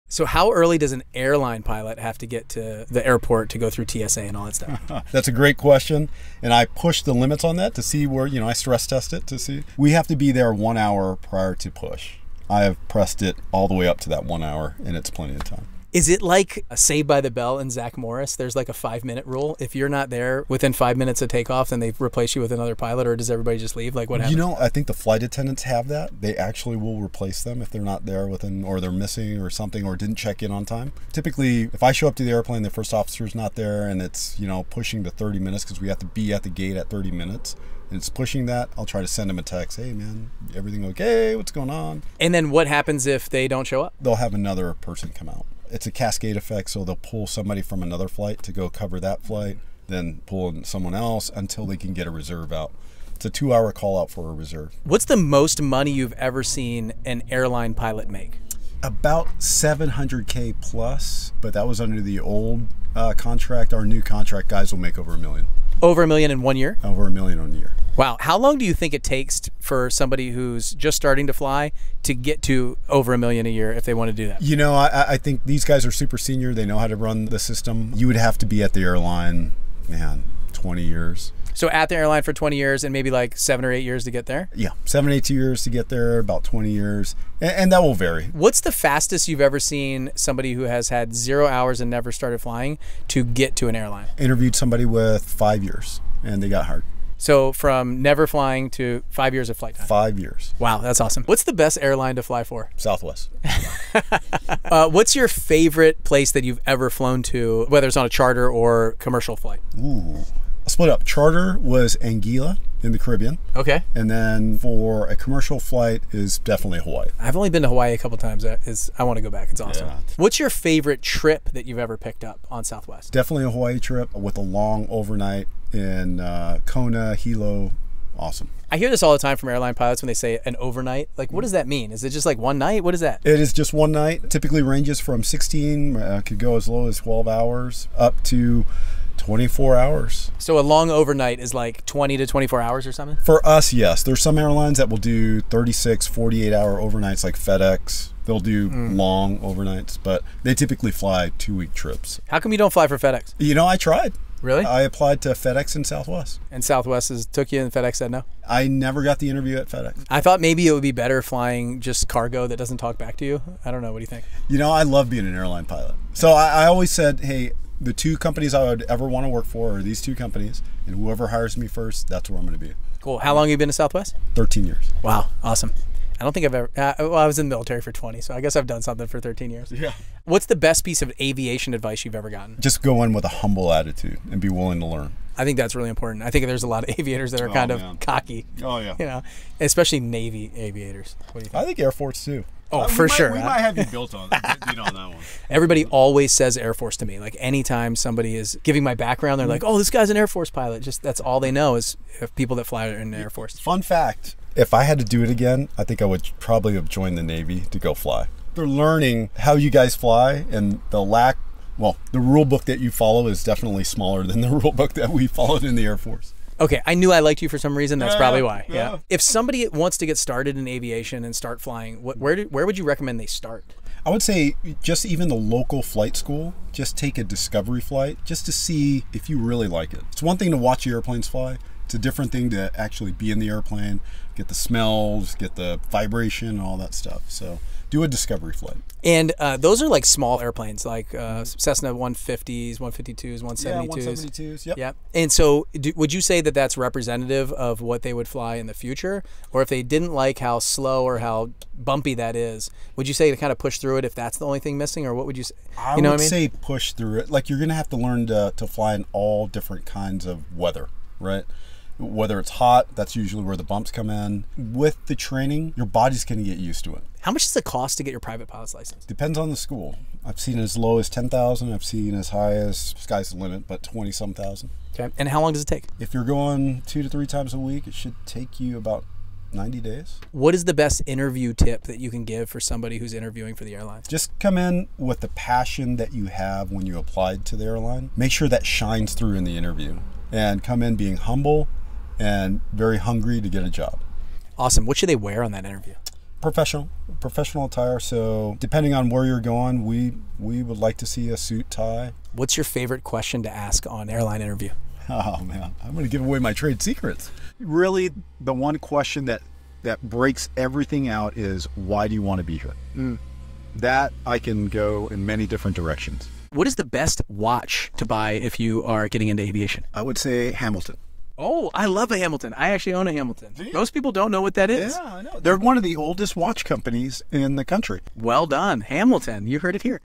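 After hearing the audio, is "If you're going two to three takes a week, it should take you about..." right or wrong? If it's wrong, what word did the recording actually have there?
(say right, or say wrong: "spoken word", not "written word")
wrong: "times", not "takes".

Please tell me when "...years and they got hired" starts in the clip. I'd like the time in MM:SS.
01:35.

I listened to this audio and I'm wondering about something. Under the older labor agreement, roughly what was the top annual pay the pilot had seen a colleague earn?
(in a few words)
700K.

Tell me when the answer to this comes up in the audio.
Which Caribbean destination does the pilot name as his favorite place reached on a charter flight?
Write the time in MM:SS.
01:52.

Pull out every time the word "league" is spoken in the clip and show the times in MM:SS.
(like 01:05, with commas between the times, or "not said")
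not said.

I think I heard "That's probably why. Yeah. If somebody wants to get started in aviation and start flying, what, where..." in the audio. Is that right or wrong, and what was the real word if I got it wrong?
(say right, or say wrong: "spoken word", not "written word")
right.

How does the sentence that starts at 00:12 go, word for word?
I have pressed it all the way up to that one hour, and it's plenty of time.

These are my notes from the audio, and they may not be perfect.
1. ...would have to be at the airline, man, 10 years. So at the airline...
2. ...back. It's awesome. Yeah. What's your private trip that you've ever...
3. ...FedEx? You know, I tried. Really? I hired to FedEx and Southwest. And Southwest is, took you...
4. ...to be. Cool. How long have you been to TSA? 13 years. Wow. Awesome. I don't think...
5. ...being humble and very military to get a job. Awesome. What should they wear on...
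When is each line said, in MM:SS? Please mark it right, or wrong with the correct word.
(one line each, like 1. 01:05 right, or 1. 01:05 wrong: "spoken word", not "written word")
1. 01:18 wrong: "20", not "10"
2. 01:59 wrong: "favorite", not "private"
3. 02:32 wrong: "applied", not "hired"
4. 02:52 wrong: "Southwest", not "TSA"
5. 04:50 wrong: "hungry", not "military".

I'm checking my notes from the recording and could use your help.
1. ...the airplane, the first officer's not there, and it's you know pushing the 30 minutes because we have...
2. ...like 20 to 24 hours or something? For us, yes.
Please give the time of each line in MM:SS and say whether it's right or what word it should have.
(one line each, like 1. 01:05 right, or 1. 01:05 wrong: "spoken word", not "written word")
1. 00:32 right
2. 02:21 right.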